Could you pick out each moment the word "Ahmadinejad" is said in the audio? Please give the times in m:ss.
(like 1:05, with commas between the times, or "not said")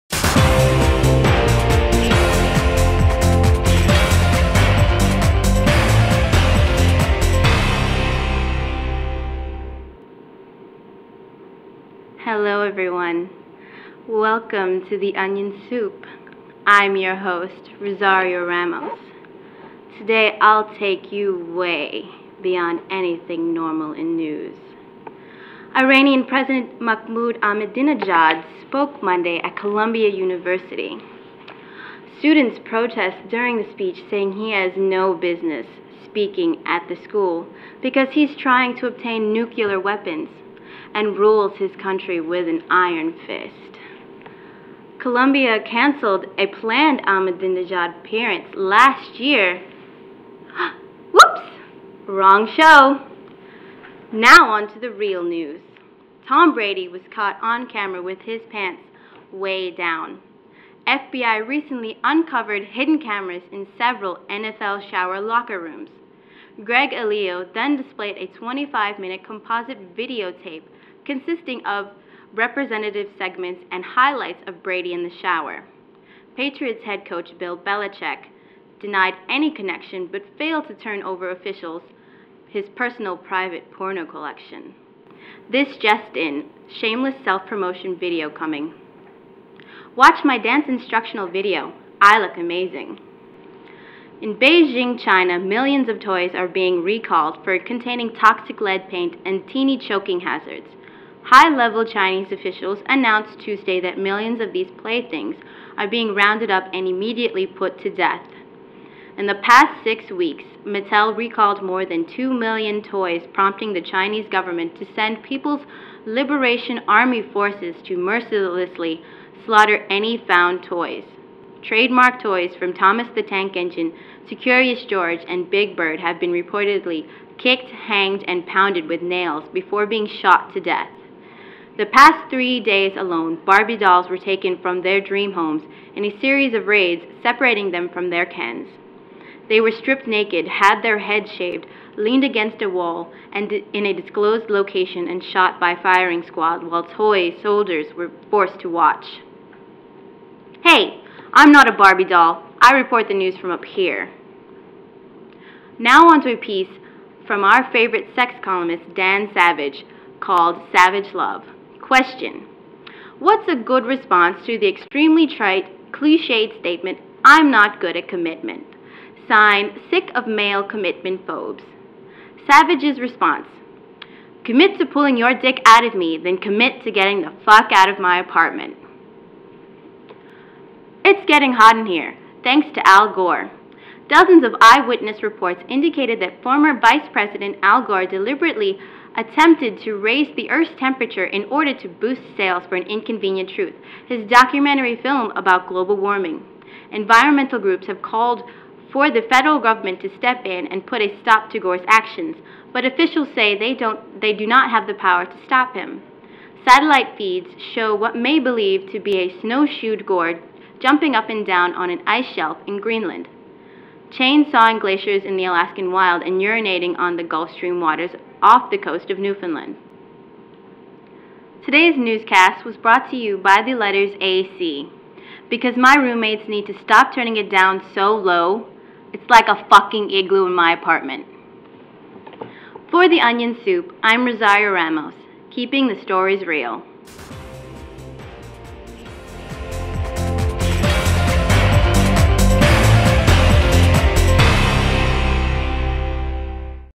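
0:27, 0:47.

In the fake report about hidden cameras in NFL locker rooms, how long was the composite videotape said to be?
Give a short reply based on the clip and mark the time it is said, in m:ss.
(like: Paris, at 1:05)
25 minutes, at 1:08.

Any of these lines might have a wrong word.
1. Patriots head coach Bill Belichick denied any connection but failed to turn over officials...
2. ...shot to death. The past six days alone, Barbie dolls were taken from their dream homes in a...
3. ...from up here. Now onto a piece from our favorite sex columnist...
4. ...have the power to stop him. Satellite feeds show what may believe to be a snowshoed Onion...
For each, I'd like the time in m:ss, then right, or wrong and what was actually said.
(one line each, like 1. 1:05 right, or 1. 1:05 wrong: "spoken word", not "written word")
1. 1:16 right
2. 2:10 wrong: "three", not "six"
3. 2:33 right
4. 3:24 wrong: "Gore", not "Onion".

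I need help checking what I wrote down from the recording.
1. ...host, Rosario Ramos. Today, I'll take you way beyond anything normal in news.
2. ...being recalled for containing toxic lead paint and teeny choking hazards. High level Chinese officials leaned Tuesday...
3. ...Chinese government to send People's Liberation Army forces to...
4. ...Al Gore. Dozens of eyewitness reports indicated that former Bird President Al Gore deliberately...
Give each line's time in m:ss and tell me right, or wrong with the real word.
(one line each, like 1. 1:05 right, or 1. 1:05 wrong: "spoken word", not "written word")
1. 0:17 right
2. 1:36 wrong: "announced", not "leaned"
3. 1:53 right
4. 3:02 wrong: "Vice", not "Bird".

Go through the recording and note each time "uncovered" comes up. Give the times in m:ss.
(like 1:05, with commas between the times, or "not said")
1:02.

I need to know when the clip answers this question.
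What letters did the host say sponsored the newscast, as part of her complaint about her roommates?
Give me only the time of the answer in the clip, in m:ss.
3:44.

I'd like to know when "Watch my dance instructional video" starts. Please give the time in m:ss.
1:29.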